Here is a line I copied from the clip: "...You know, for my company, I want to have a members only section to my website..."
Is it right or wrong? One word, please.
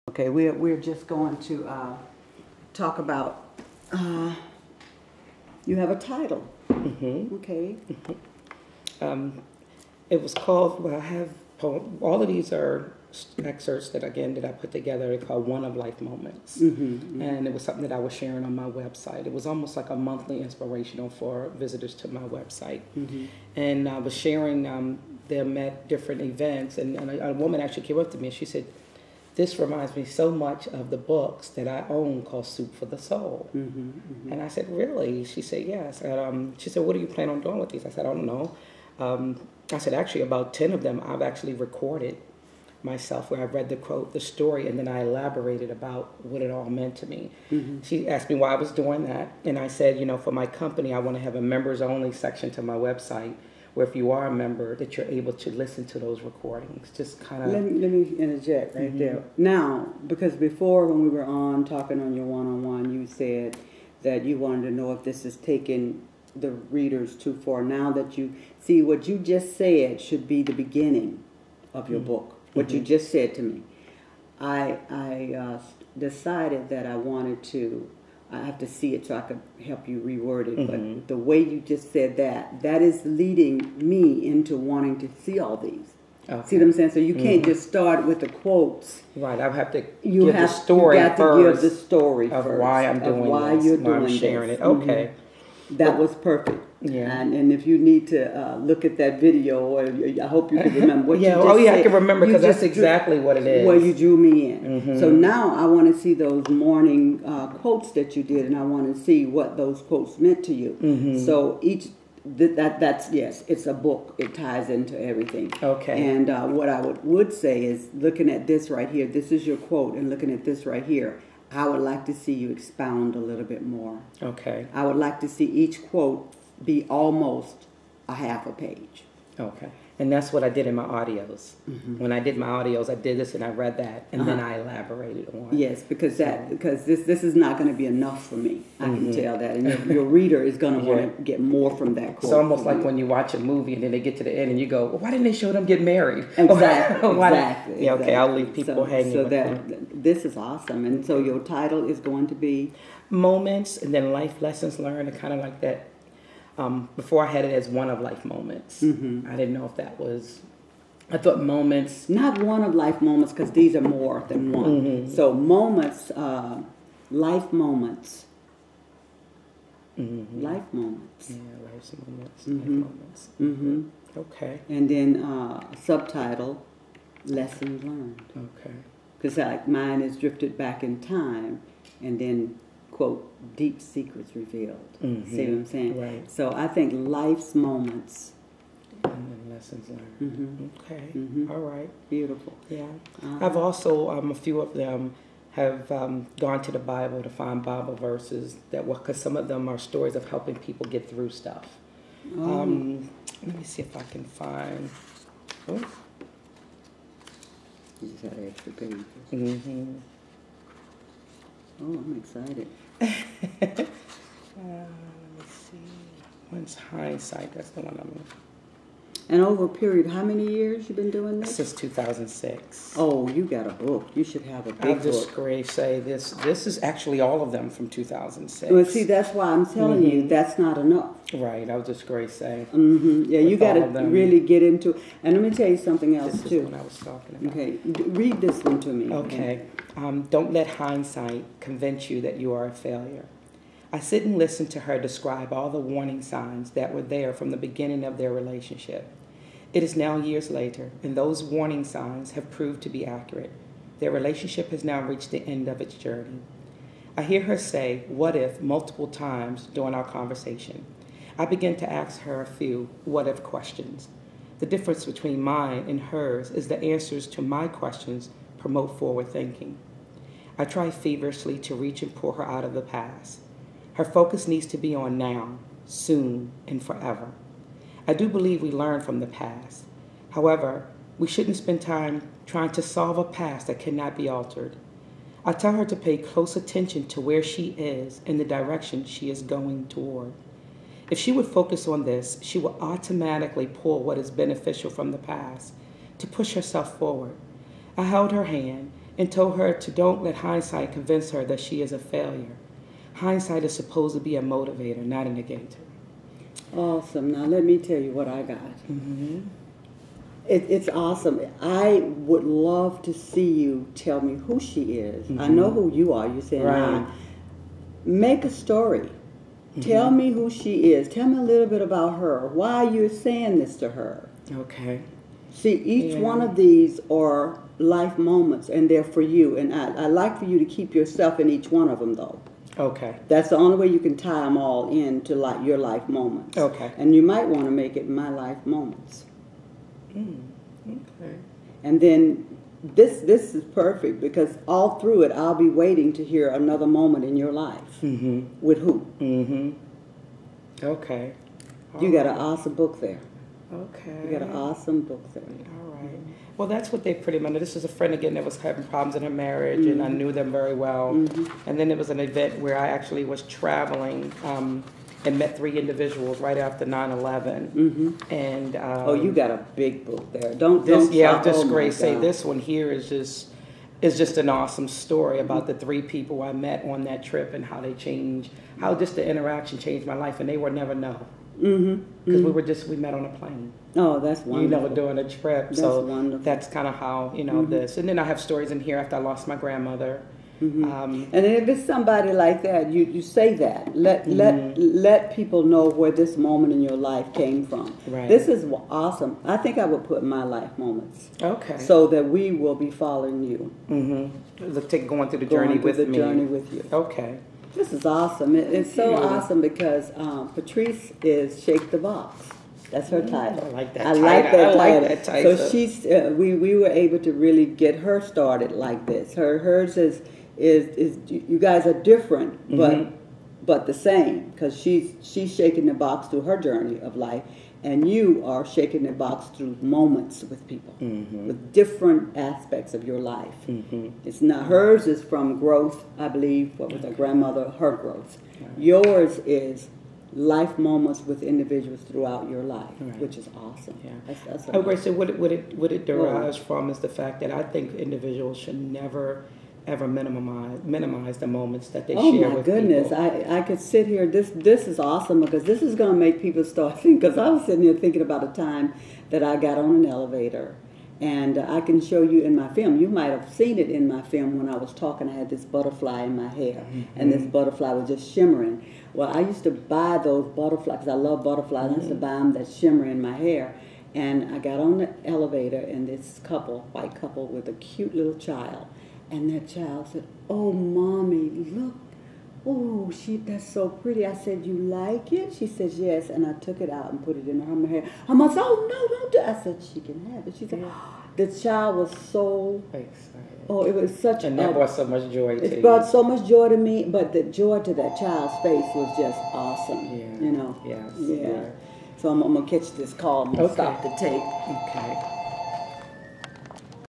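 right.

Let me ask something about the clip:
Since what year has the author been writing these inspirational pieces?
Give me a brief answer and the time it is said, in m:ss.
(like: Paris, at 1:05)
2006, at 3:41.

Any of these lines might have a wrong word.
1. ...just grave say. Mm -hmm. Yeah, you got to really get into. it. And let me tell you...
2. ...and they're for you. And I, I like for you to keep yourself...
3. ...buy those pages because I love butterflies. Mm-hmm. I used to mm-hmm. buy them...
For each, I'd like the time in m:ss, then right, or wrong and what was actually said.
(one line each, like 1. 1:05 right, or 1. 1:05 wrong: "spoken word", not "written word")
1. 3:51 right
2. 5:28 right
3. 7:49 wrong: "butterflies", not "pages".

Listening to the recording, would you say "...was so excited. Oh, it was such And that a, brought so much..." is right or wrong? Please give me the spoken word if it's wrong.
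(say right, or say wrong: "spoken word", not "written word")
right.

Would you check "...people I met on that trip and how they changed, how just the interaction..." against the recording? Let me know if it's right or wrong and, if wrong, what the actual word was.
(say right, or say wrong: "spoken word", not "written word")
right.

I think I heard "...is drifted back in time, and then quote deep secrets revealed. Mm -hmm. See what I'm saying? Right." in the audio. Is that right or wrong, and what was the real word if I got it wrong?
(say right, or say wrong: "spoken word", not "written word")
right.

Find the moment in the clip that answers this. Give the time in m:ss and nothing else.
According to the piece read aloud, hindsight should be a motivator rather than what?
5:05.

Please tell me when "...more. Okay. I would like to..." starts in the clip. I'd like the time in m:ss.
2:03.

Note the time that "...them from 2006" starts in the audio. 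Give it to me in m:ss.
3:47.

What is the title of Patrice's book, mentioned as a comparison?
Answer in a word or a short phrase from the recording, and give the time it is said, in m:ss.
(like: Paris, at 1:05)
Shake the Box, at 6:51.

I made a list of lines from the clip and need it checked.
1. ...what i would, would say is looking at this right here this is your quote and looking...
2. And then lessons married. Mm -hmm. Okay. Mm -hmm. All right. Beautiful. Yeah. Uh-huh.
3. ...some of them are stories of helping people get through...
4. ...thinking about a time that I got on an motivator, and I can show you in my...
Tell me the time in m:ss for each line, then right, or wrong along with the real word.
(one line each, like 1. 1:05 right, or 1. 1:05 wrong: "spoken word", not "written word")
1. 1:56 right
2. 3:09 wrong: "learned", not "married"
3. 3:19 right
4. 7:37 wrong: "elevator", not "motivator".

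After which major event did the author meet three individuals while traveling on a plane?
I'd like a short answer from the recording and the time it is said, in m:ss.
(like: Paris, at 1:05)
9-11, at 6:06.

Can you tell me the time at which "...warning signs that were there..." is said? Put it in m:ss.
4:05.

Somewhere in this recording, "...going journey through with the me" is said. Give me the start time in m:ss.
6:45.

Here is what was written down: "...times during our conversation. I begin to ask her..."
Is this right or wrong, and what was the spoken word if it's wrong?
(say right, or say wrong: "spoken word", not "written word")
right.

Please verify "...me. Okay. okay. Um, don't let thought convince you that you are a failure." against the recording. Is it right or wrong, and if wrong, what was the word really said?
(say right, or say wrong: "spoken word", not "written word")
wrong: "hindsight", not "thought".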